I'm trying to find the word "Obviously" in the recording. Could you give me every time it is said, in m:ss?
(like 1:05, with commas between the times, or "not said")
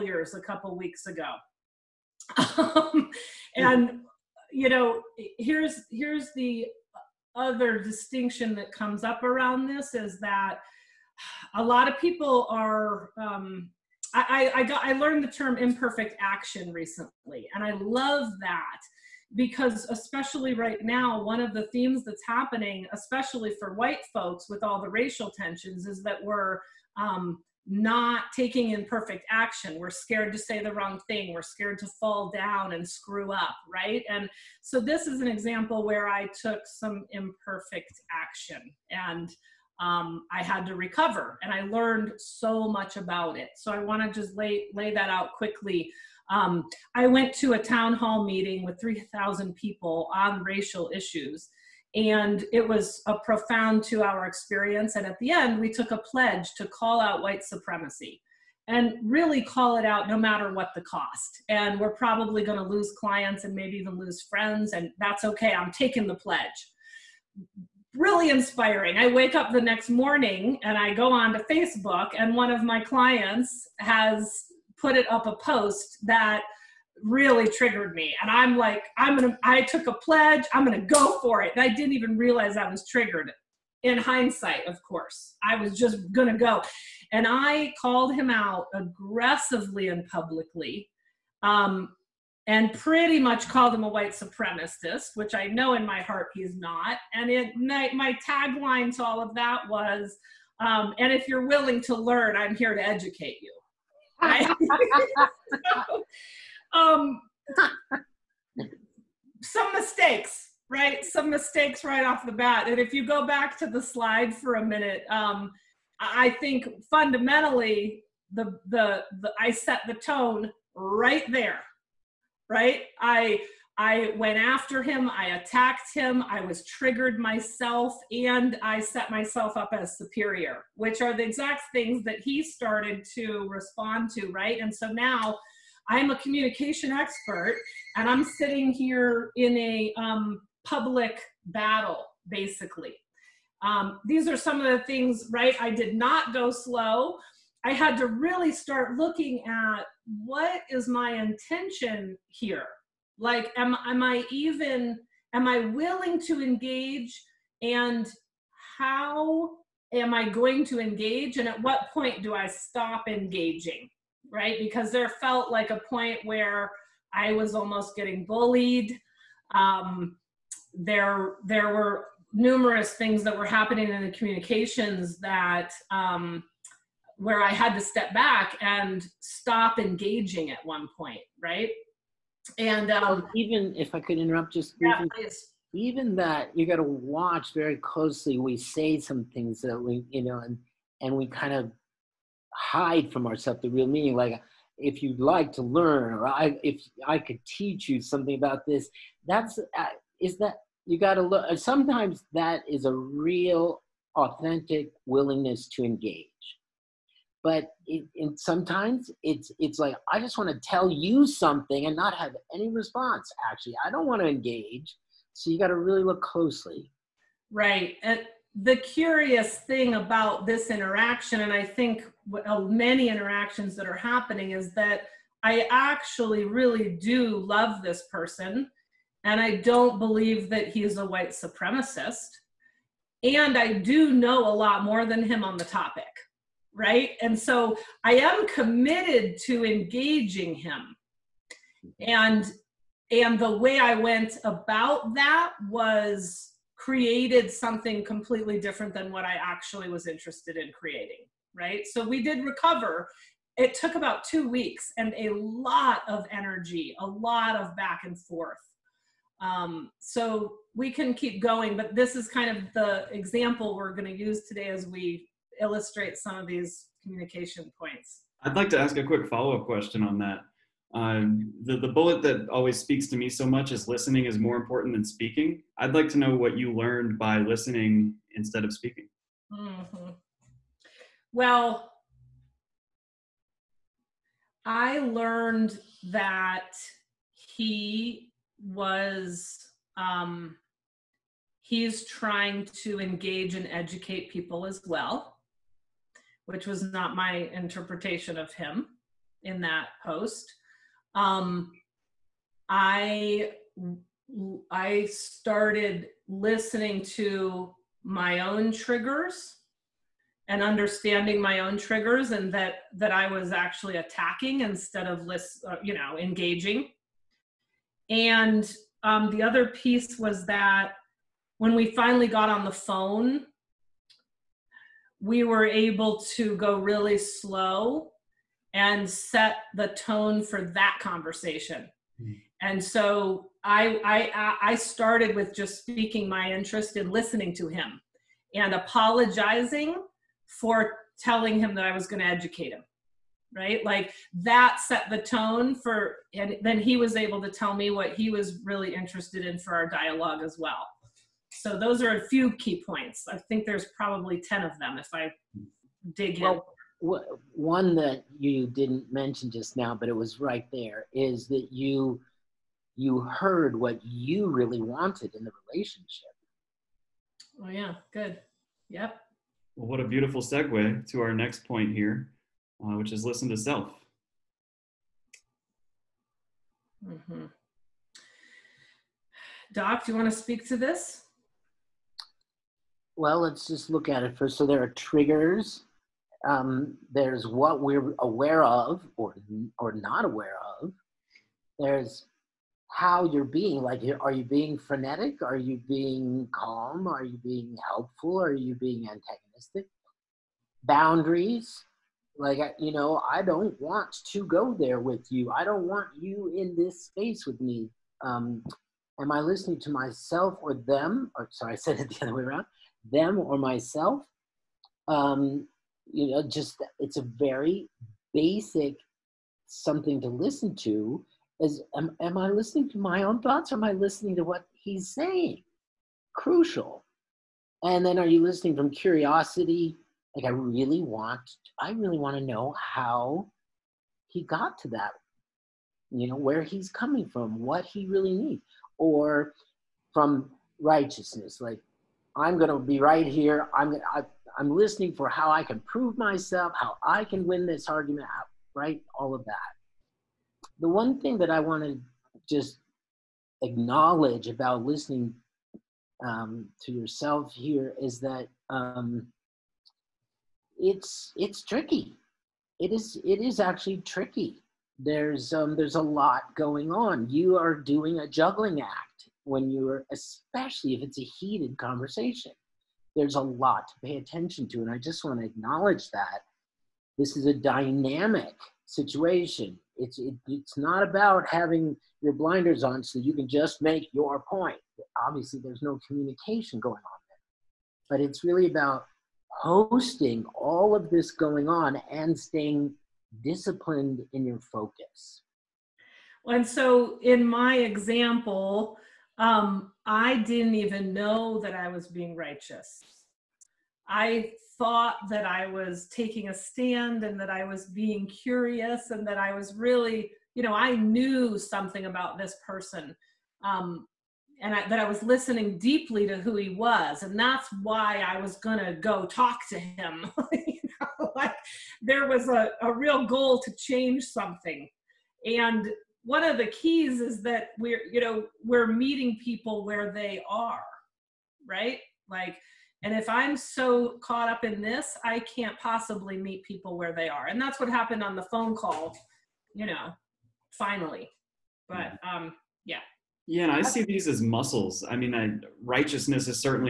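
8:05.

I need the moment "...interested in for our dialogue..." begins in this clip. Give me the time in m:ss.
5:48.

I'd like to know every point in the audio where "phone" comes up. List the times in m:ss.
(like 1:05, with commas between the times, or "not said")
5:22, 8:58.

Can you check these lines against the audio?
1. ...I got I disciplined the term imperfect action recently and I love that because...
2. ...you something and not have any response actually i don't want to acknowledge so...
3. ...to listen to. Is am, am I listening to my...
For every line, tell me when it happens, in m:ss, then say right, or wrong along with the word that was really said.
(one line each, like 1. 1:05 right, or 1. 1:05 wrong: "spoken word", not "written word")
1. 0:14 wrong: "learned", not "disciplined"
2. 3:30 wrong: "engage", not "acknowledge"
3. 7:00 right.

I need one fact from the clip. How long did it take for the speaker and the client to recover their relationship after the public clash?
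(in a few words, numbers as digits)
about 2 weeks.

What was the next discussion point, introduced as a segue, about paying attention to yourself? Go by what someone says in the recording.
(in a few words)
listen to self.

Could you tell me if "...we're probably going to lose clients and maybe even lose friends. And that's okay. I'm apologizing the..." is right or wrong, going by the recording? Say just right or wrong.
wrong.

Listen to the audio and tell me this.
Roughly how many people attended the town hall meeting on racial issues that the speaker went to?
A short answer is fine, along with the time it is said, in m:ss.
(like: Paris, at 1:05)
3,000, at 0:48.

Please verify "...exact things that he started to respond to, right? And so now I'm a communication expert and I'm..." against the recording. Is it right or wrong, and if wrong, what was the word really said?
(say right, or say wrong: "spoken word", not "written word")
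right.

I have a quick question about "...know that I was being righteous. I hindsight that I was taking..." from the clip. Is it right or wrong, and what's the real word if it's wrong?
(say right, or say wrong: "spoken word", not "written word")
wrong: "thought", not "hindsight".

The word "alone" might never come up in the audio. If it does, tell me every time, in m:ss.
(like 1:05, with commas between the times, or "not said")
not said.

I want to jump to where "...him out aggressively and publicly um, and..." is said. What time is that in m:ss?
1:28.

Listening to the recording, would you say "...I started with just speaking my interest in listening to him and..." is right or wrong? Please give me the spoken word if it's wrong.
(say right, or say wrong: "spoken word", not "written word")
right.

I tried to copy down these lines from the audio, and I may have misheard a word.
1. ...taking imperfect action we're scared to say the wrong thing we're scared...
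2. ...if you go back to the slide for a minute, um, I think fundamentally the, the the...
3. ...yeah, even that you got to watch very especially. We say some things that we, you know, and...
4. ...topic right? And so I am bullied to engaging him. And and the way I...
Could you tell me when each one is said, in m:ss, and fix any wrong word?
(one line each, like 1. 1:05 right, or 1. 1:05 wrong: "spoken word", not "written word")
1. 0:28 right
2. 1:52 right
3. 3:05 wrong: "closely", not "especially"
4. 3:55 wrong: "committed", not "bullied".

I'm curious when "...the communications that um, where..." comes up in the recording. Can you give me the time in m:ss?
2:54.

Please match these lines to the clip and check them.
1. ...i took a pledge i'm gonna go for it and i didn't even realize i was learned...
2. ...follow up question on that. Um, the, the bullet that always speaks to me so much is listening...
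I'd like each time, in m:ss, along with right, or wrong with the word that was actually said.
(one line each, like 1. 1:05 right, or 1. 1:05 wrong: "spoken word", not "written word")
1. 1:19 wrong: "triggered", not "learned"
2. 4:29 right.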